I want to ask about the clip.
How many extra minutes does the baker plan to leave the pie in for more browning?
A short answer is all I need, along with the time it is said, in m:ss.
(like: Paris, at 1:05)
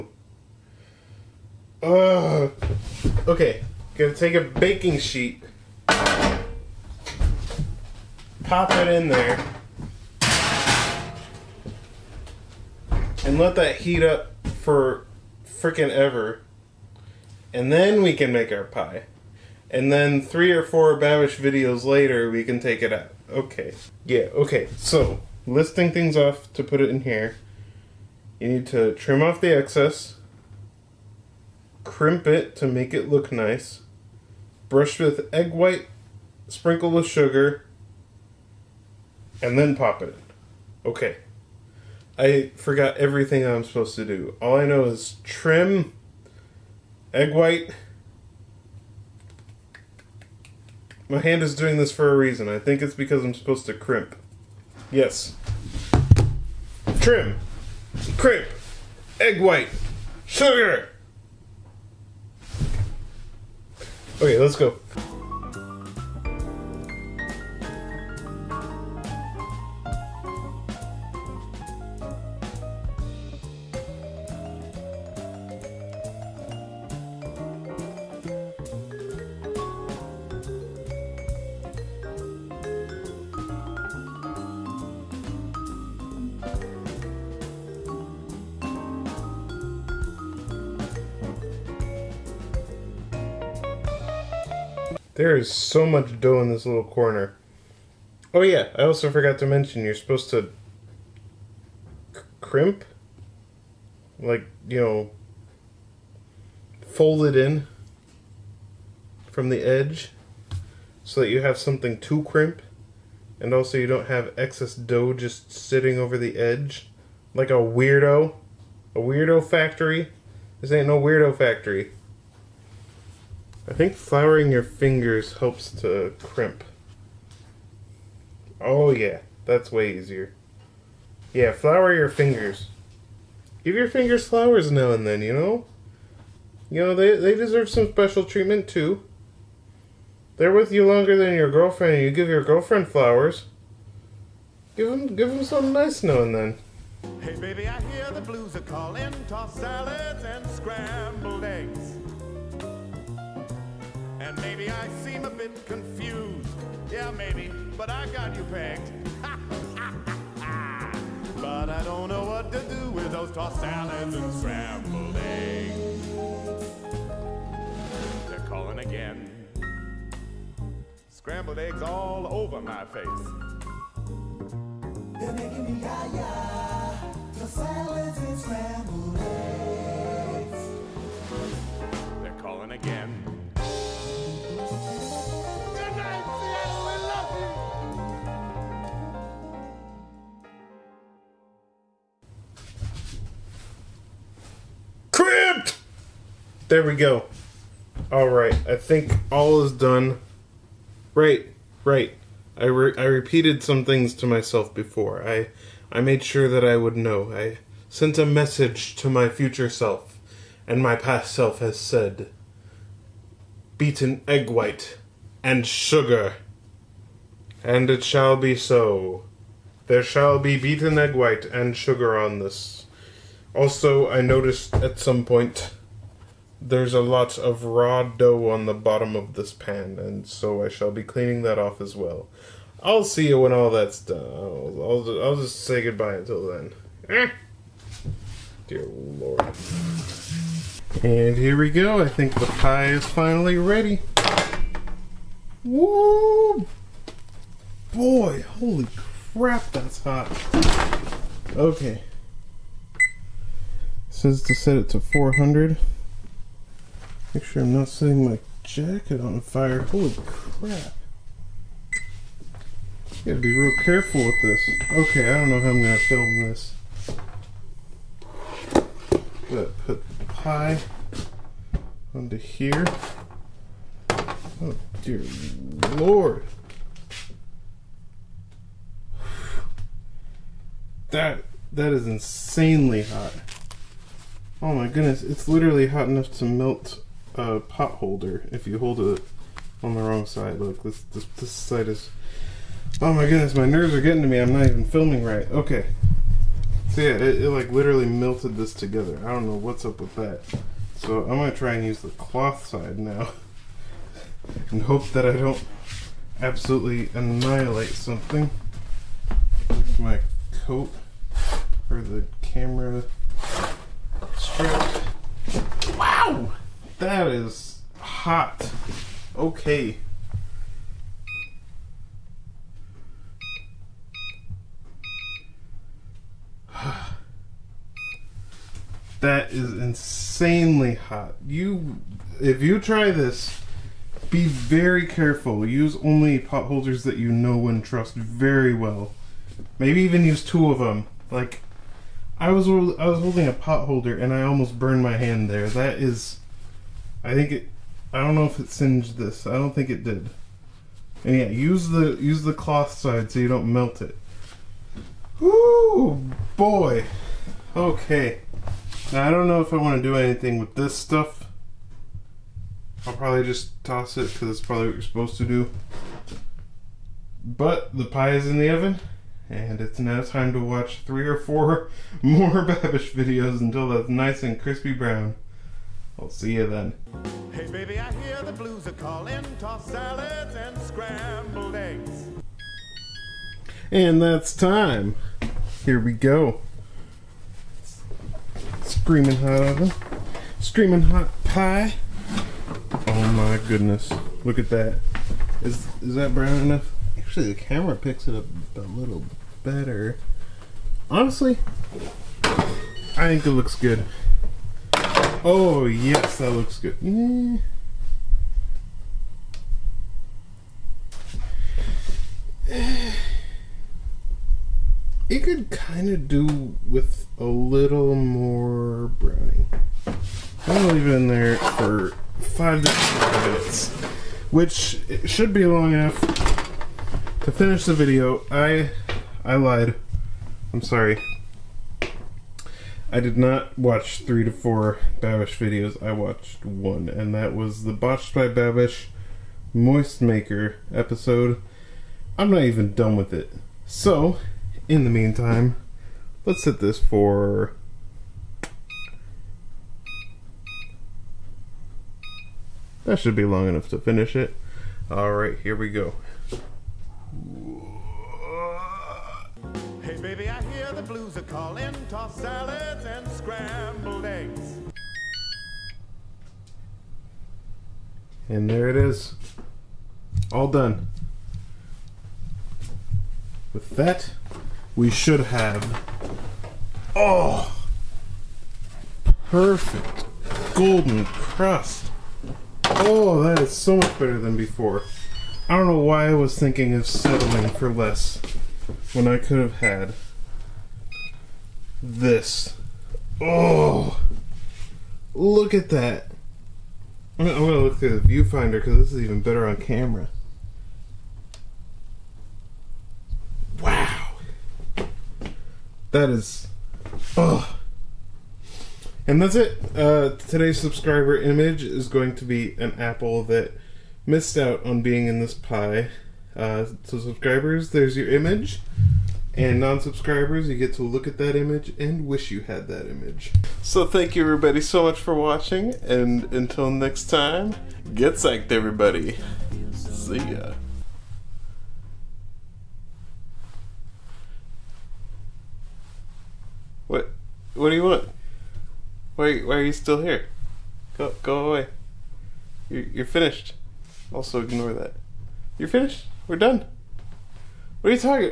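5 to 10 minutes, at 7:02.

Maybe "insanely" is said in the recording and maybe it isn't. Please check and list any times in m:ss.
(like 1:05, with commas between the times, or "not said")
4:42, 5:29.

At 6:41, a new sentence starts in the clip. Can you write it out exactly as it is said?
Honestly, I think it looks good.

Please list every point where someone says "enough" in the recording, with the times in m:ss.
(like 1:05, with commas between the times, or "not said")
4:46, 6:36, 7:05, 7:33.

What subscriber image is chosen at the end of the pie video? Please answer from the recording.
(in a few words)
an apple.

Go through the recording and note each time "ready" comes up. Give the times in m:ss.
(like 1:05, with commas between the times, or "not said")
4:03.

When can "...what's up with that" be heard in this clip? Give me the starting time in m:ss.
4:59.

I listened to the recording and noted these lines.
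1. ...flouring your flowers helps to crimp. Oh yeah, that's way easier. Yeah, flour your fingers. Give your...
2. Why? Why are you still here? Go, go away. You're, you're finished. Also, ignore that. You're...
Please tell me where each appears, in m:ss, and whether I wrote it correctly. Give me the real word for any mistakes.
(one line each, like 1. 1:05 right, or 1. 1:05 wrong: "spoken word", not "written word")
1. 2:03 wrong: "fingers", not "flowers"
2. 8:59 right.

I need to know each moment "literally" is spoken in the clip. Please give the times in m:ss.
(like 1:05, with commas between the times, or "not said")
4:45, 4:57.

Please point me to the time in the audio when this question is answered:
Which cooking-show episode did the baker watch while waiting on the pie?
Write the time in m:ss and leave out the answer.
7:19.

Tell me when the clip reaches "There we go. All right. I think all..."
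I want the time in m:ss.
3:16.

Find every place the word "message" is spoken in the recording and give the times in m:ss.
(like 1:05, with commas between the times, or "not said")
3:28.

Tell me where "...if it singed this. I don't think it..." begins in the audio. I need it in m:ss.
5:48.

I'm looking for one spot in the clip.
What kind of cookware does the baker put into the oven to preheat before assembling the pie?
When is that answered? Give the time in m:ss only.
0:04.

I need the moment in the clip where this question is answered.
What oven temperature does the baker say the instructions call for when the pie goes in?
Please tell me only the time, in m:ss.
4:14.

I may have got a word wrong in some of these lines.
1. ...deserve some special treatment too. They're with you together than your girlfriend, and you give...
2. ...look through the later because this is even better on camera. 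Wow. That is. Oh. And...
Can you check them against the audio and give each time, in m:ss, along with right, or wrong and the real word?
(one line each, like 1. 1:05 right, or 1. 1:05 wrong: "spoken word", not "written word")
1. 2:17 wrong: "longer", not "together"
2. 8:17 wrong: "viewfinder", not "later".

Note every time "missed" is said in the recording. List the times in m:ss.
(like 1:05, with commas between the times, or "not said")
8:34.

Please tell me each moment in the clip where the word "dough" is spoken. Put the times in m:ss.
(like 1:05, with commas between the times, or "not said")
1:36, 1:54, 3:48.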